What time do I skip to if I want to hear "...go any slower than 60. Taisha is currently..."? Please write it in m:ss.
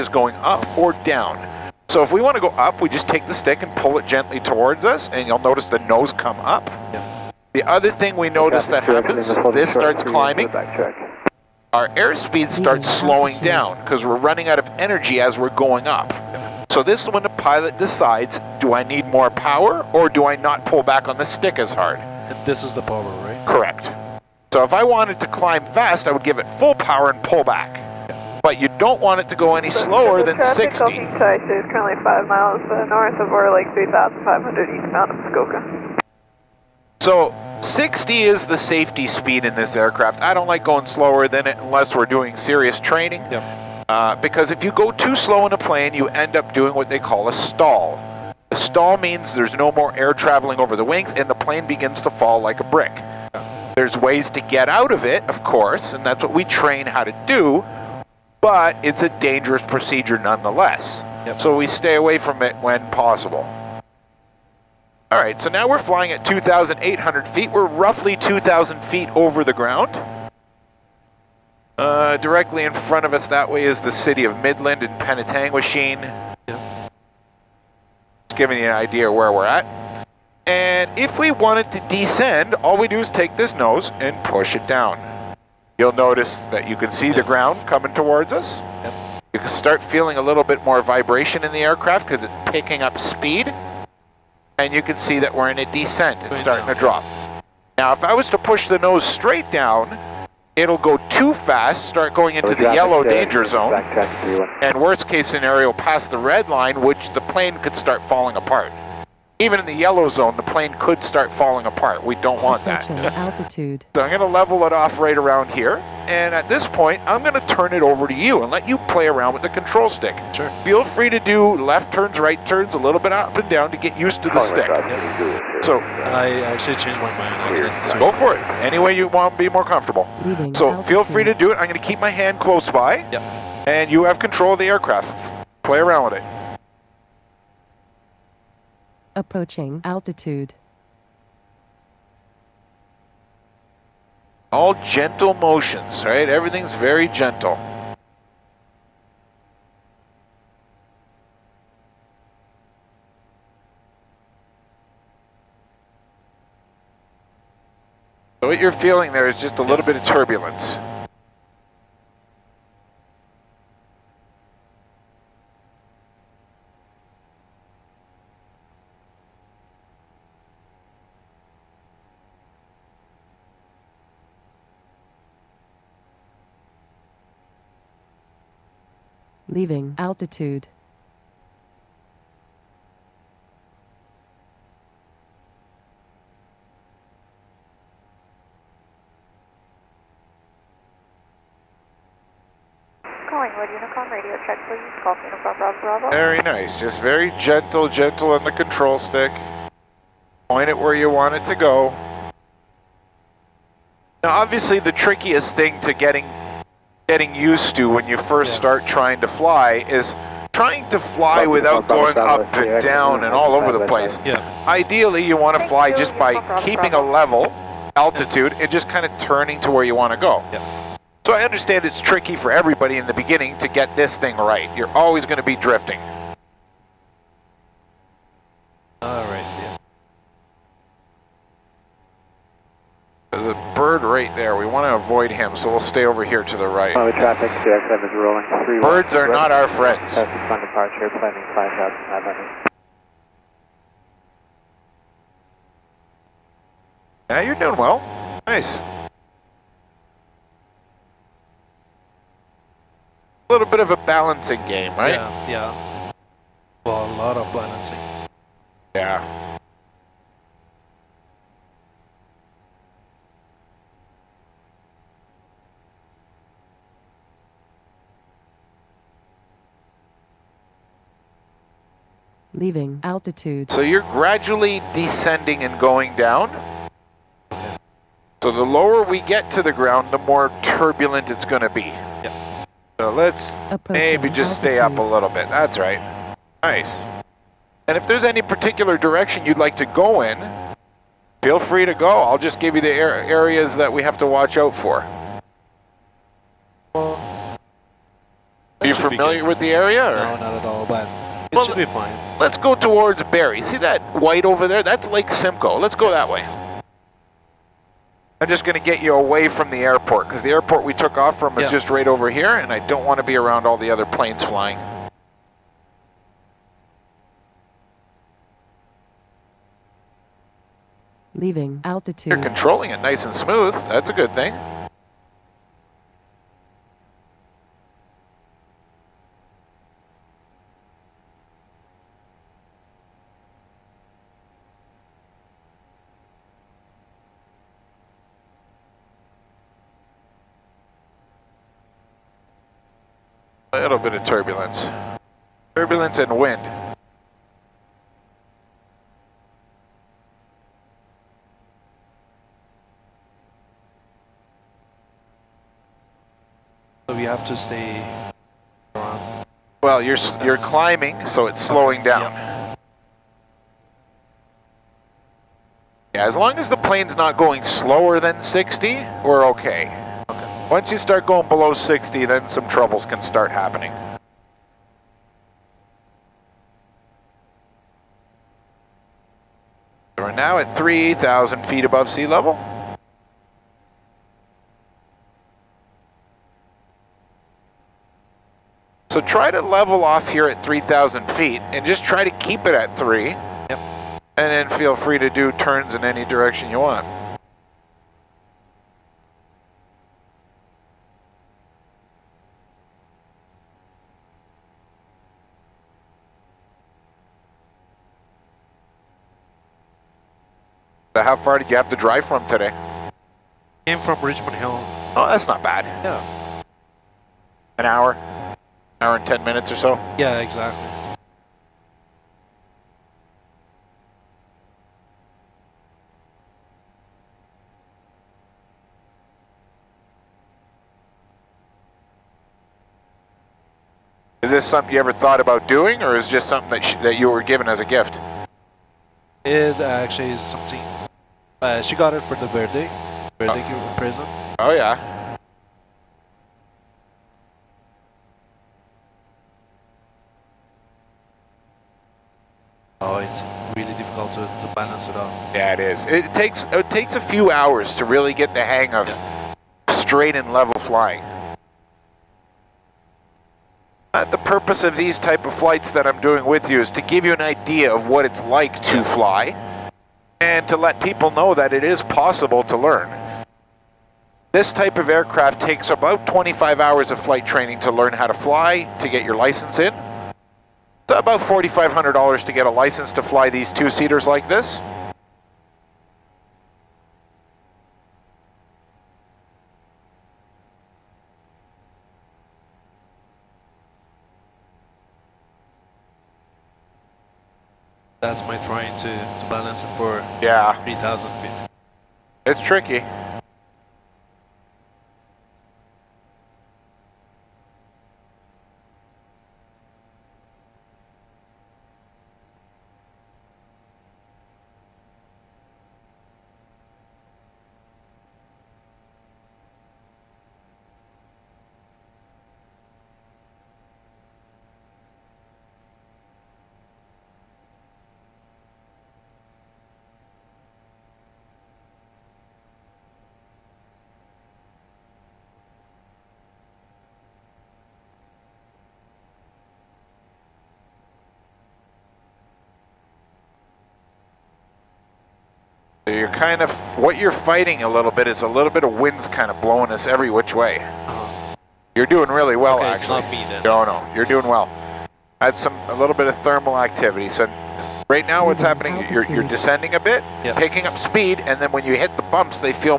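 0:29.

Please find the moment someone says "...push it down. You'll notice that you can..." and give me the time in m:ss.
1:24.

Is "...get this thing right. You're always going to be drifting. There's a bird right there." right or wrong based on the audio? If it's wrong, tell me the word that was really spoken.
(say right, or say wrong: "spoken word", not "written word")
right.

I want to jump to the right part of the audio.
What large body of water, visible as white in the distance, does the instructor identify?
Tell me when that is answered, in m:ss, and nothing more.
5:05.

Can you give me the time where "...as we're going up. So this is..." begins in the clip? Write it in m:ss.
0:15.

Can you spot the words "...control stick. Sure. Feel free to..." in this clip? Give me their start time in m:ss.
1:59.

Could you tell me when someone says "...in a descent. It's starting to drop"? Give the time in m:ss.
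1:35.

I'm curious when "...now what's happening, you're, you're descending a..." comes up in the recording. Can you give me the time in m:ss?
9:18.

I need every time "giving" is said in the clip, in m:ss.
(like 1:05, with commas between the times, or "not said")
1:18.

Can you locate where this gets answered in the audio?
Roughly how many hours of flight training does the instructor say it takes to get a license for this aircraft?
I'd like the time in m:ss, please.
7:56.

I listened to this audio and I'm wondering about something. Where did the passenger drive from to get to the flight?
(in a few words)
Richmond Hill.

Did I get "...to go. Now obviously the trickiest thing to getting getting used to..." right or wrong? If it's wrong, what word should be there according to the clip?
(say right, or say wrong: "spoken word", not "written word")
right.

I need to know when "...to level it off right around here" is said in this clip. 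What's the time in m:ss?
1:54.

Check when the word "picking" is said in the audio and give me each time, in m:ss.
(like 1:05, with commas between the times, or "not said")
1:32, 9:20.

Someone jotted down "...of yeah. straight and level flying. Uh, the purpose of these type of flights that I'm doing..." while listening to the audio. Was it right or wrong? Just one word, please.
right.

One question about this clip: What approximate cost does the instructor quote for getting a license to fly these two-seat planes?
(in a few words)
$4,500.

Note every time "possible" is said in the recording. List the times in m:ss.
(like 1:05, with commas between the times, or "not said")
1:02, 7:52.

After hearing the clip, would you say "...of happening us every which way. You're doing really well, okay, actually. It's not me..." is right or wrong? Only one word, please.
wrong.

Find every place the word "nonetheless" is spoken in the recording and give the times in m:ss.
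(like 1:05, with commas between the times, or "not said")
1:00.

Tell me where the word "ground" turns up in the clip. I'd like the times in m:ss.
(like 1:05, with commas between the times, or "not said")
1:09, 1:27, 4:39.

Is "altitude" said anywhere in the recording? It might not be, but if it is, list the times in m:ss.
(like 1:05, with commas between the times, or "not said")
1:53, 2:19, 2:59, 3:37, 4:33, 4:44, 5:21.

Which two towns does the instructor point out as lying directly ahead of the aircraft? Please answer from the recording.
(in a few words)
Midland and Penetanguishene.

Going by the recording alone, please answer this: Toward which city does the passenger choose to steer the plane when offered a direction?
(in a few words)
Barrie.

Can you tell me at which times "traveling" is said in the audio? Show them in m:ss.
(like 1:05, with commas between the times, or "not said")
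0:50.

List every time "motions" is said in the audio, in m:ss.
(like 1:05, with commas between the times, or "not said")
2:25.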